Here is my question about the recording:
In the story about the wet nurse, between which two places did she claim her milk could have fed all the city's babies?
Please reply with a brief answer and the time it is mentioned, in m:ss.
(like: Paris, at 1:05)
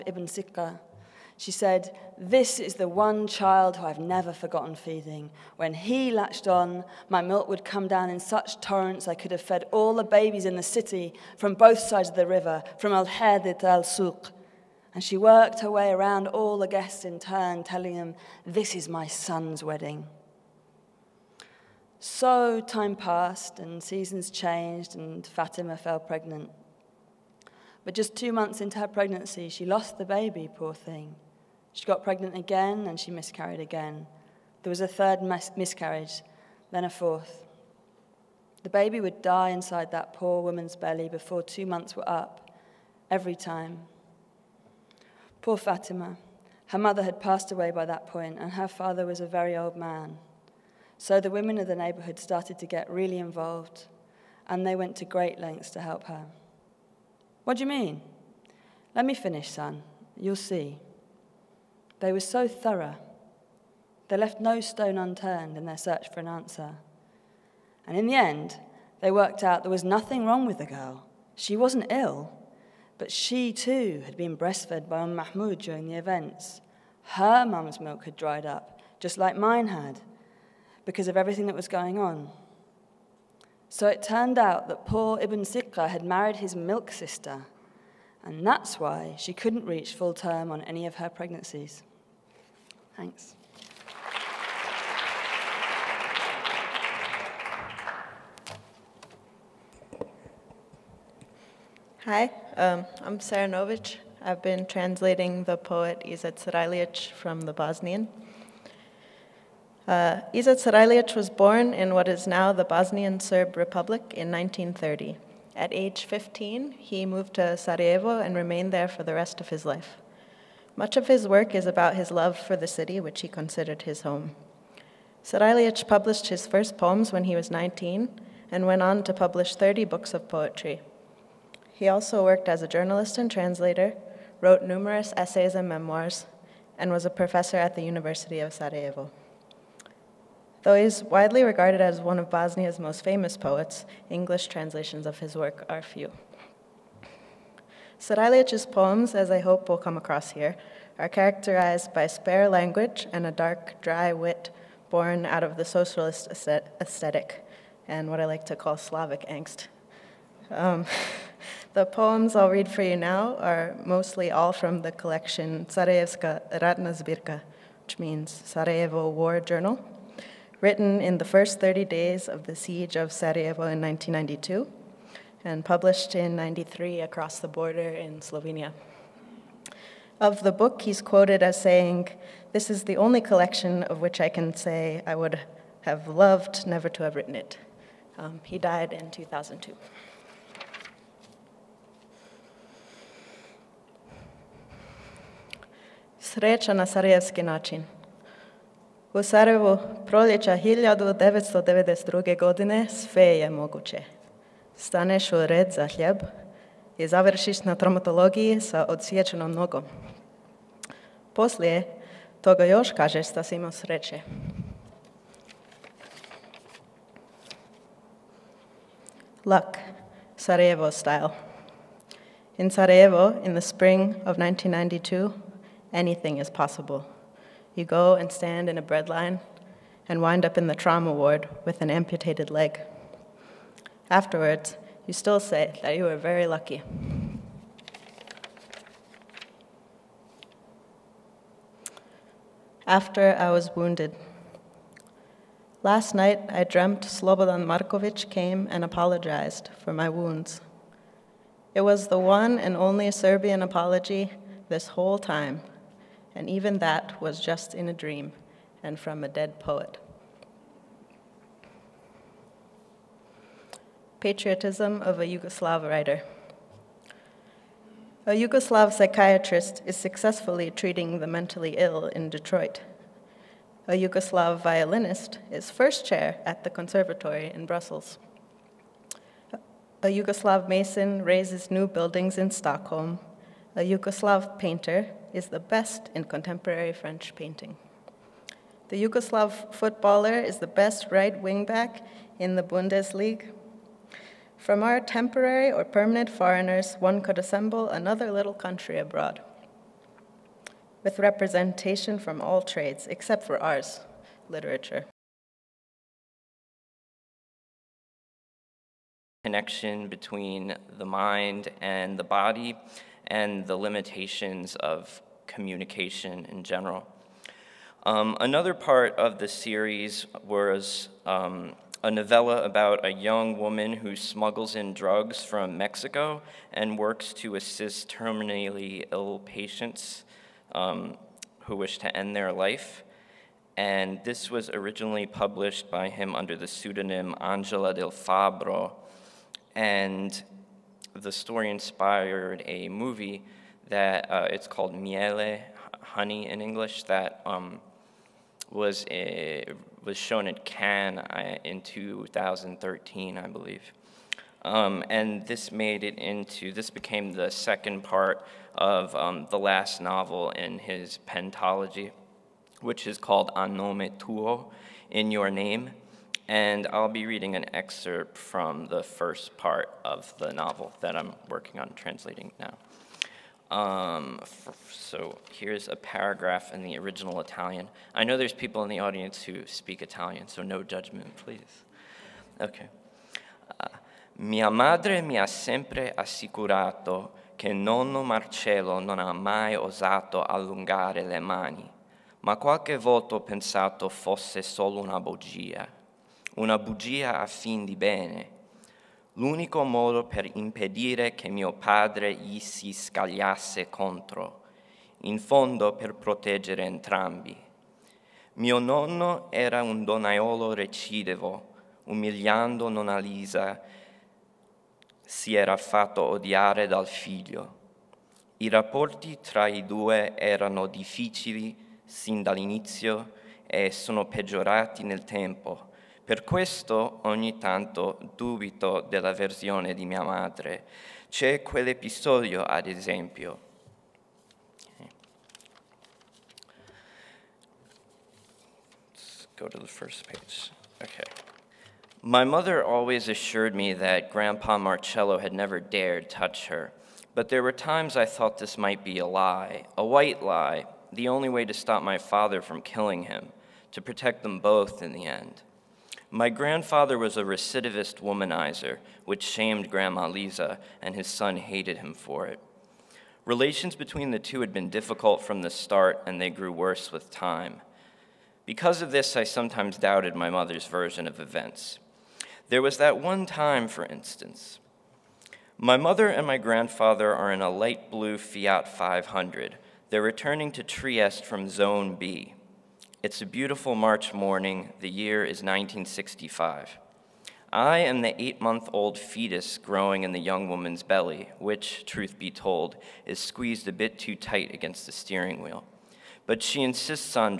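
Al Hadid to Al Suq, at 0:12.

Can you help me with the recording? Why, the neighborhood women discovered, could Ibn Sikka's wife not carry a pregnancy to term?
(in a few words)
milk sister.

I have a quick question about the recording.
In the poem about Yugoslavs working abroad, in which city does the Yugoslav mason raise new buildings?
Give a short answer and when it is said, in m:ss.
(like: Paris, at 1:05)
Stockholm, at 4:42.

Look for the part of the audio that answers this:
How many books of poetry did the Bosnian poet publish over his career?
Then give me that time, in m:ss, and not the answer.
2:09.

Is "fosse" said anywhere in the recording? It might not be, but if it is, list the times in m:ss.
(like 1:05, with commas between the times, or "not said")
6:34.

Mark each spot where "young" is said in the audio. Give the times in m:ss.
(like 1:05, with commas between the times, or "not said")
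5:23, 8:10.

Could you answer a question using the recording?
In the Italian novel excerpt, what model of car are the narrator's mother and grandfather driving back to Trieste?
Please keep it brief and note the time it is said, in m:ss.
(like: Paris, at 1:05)
Fiat 500, at 7:58.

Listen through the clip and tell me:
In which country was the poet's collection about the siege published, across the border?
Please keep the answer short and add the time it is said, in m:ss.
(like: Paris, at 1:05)
Slovenia, at 2:58.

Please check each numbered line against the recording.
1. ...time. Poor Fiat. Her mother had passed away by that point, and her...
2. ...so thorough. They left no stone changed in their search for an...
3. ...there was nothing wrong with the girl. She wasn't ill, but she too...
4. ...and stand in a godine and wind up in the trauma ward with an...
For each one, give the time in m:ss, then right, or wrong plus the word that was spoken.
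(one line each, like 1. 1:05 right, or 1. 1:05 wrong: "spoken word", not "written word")
1. 0:43 wrong: "Fatima", not "Fiat"
2. 1:02 wrong: "unturned", not "changed"
3. 1:09 right
4. 3:48 wrong: "breadline", not "godine".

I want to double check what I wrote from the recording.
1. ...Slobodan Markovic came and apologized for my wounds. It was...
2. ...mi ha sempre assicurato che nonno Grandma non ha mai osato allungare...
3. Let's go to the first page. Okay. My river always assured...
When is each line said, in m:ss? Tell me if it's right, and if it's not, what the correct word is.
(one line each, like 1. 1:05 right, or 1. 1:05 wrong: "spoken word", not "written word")
1. 4:07 right
2. 6:25 wrong: "Marcello", not "Grandma"
3. 7:19 wrong: "mother", not "river".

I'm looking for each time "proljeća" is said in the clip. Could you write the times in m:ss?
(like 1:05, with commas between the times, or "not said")
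3:20.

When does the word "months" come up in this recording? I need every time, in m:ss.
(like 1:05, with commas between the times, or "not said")
0:28, 0:41, 8:08.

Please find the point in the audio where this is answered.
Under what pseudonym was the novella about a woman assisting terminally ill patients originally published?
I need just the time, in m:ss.
5:37.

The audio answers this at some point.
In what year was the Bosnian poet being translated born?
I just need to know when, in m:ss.
1:54.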